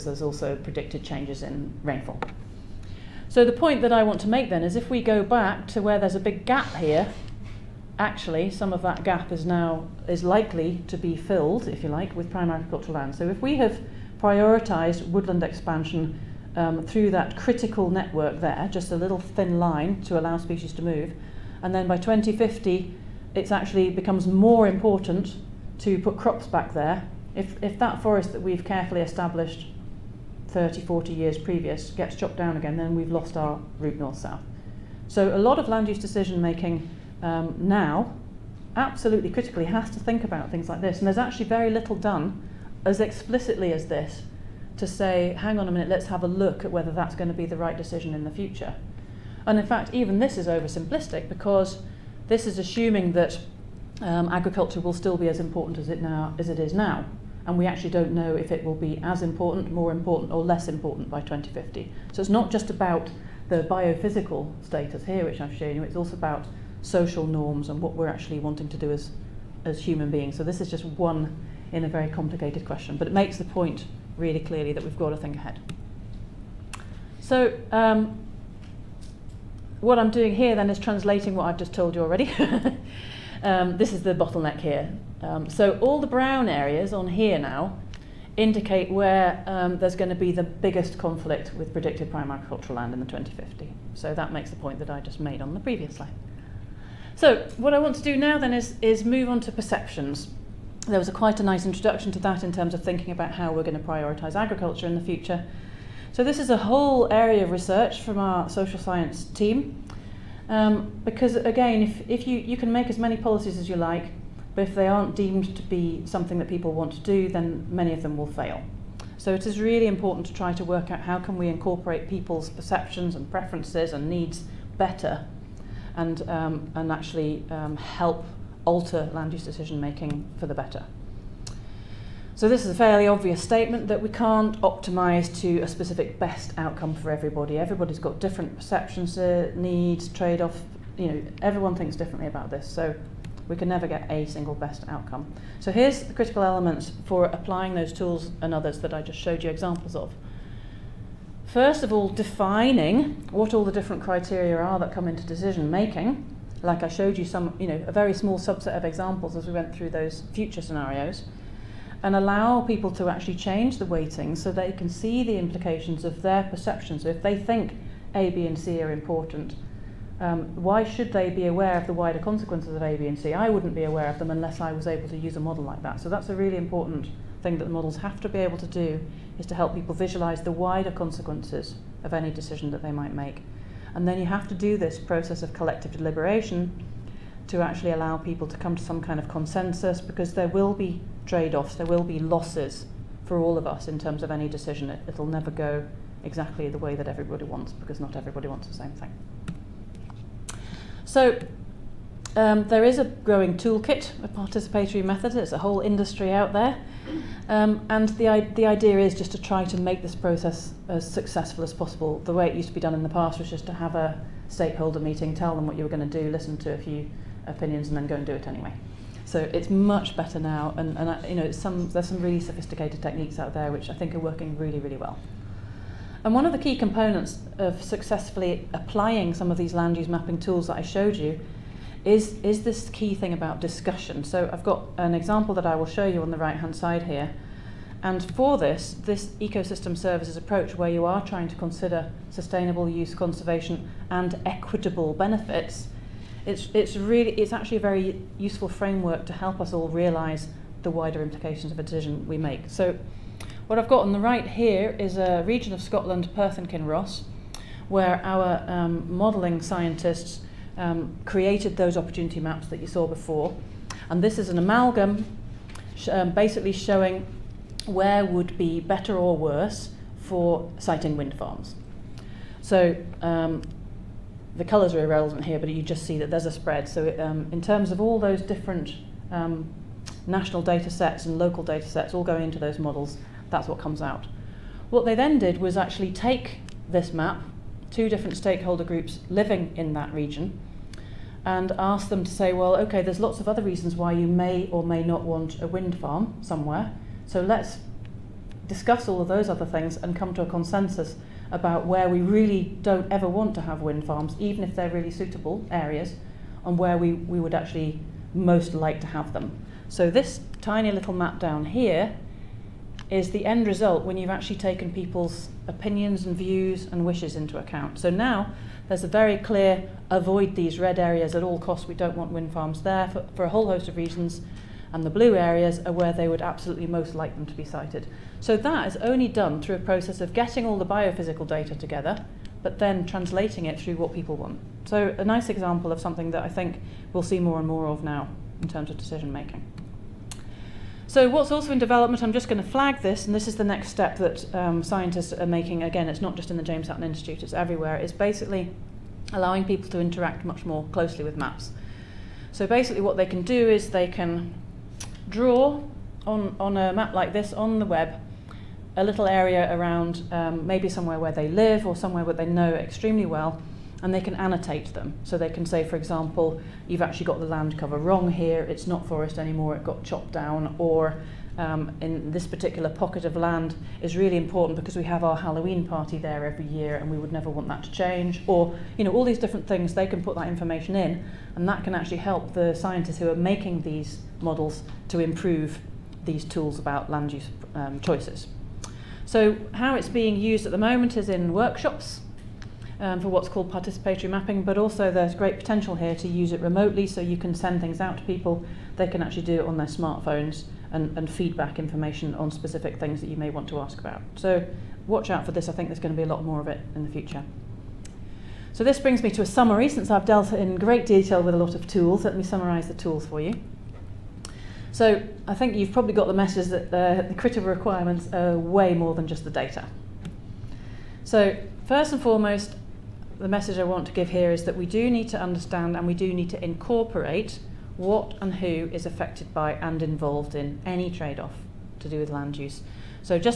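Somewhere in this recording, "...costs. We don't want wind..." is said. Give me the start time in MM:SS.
05:21.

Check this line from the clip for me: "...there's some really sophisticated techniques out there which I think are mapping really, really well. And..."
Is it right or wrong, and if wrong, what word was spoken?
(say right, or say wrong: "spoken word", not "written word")
wrong: "working", not "mapping".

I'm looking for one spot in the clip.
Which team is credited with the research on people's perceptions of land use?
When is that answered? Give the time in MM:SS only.
01:48.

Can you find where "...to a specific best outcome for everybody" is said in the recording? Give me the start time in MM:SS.
02:15.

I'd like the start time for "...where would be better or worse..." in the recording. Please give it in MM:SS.
04:27.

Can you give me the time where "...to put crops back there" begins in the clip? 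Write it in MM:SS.
00:25.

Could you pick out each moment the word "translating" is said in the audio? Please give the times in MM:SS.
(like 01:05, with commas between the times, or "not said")
01:20, 05:33.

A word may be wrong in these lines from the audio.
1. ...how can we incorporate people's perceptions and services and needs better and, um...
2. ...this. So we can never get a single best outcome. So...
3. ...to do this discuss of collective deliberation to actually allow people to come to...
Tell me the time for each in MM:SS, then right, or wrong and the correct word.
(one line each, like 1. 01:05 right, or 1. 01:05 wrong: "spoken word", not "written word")
1. 02:01 wrong: "preferences", not "services"
2. 02:22 right
3. 03:04 wrong: "process", not "discuss".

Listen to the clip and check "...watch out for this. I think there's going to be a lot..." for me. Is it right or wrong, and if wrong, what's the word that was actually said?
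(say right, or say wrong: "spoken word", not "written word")
right.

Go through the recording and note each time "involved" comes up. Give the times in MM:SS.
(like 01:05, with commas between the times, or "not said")
07:10.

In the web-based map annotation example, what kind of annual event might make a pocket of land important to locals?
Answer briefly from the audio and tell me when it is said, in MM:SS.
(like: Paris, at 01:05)
Halloween party, at 06:15.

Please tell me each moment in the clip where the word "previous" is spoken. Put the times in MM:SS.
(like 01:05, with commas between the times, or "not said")
00:31, 01:35.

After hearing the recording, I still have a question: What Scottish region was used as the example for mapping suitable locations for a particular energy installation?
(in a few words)
Perth and Kinross.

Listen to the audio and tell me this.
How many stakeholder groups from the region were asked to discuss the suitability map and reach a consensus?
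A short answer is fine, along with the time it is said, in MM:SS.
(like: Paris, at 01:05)
2, at 04:47.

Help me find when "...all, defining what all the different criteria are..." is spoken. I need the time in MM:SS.
02:31.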